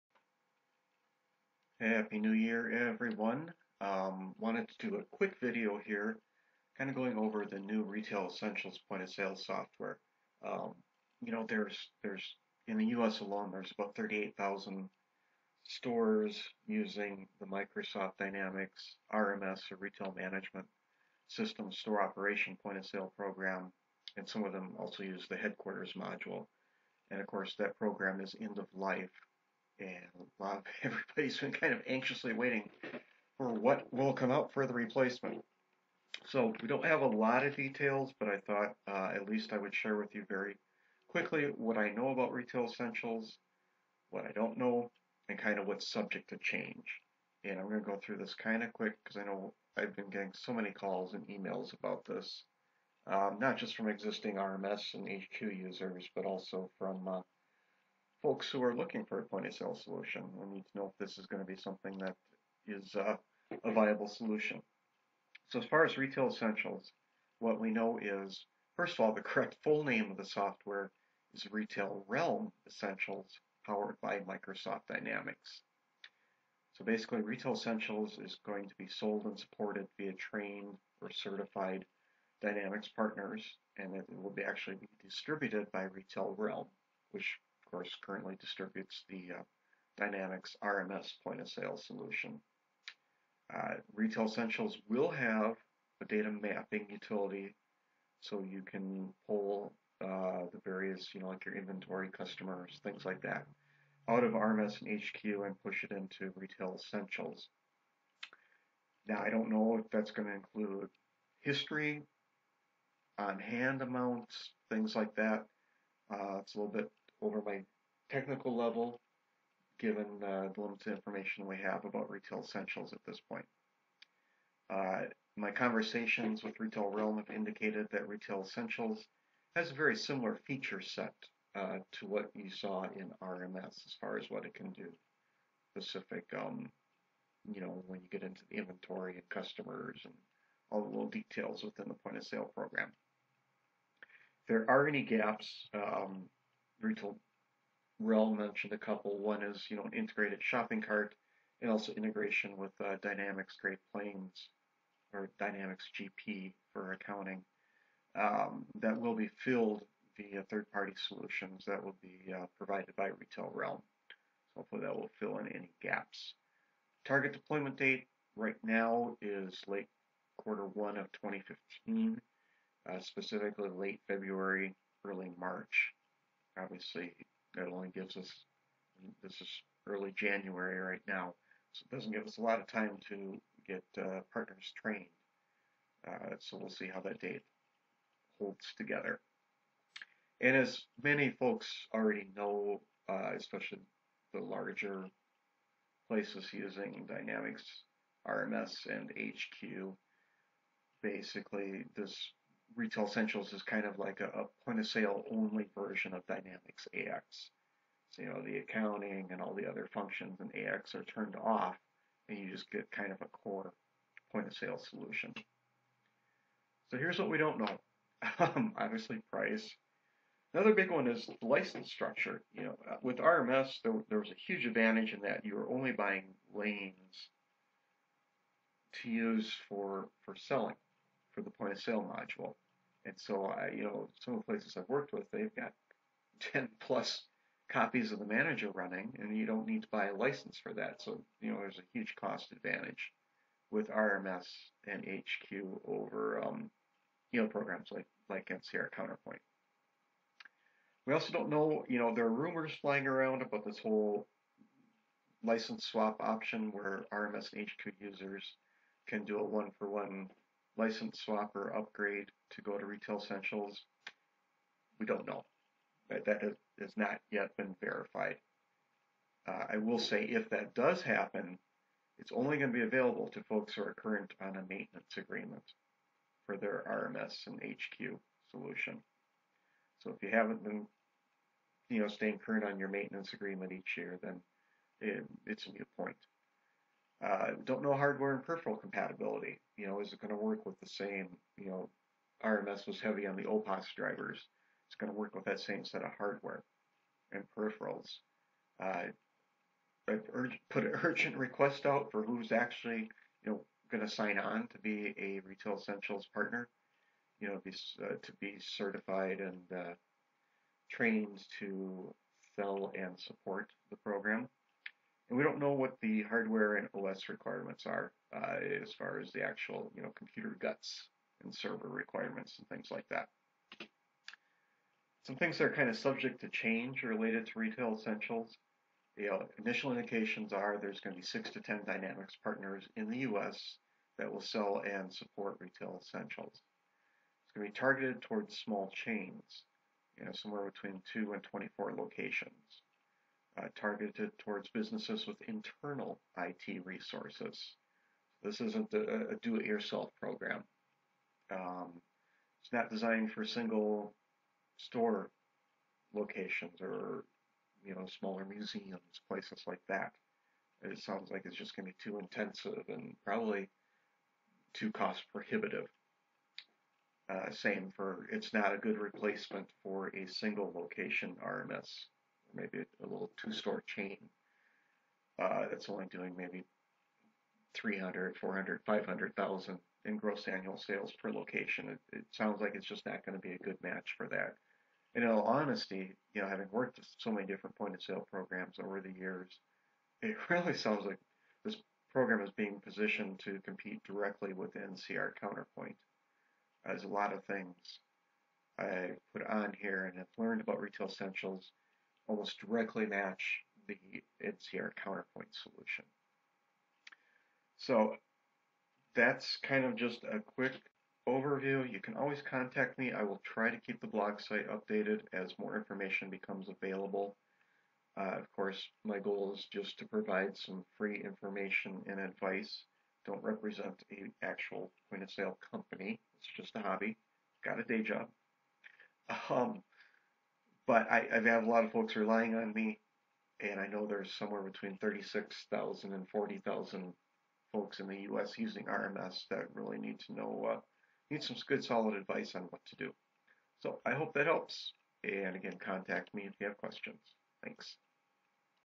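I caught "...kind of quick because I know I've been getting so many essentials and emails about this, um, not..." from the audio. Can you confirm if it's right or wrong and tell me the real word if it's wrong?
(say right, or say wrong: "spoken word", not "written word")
wrong: "calls", not "essentials".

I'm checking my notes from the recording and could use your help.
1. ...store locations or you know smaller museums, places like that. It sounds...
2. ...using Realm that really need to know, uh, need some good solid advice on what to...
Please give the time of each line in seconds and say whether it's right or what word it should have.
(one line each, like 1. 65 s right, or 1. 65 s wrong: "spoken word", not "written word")
1. 354 s right
2. 438 s wrong: "RMS", not "Realm".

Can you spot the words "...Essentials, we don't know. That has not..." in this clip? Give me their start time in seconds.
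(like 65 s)
263 s.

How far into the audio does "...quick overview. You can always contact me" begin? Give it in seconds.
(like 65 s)
410 s.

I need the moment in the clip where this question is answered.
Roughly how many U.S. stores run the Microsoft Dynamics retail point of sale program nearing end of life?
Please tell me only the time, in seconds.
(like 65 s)
13 s.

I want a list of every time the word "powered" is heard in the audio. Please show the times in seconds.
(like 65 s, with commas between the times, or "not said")
73 s.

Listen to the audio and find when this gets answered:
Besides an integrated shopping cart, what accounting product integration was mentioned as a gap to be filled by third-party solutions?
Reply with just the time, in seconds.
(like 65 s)
155 s.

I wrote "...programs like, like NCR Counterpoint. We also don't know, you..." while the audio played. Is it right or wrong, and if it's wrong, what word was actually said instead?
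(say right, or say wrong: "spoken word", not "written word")
right.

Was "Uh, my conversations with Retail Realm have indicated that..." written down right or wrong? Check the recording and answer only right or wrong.
right.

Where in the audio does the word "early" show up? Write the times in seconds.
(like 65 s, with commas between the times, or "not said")
175 s, 179 s.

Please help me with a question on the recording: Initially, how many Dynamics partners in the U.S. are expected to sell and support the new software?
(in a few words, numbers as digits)
6 to 10.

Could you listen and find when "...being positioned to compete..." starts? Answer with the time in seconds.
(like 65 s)
392 s.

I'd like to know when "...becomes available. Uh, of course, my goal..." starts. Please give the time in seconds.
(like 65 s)
416 s.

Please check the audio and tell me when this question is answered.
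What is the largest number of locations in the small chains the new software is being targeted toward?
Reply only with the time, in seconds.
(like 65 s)
341 s.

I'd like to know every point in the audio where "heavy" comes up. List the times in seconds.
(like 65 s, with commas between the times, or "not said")
292 s.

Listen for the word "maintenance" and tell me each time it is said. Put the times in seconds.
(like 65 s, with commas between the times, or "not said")
274 s, 282 s.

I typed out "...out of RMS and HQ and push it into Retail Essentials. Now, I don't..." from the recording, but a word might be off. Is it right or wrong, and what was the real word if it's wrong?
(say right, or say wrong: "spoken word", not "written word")
right.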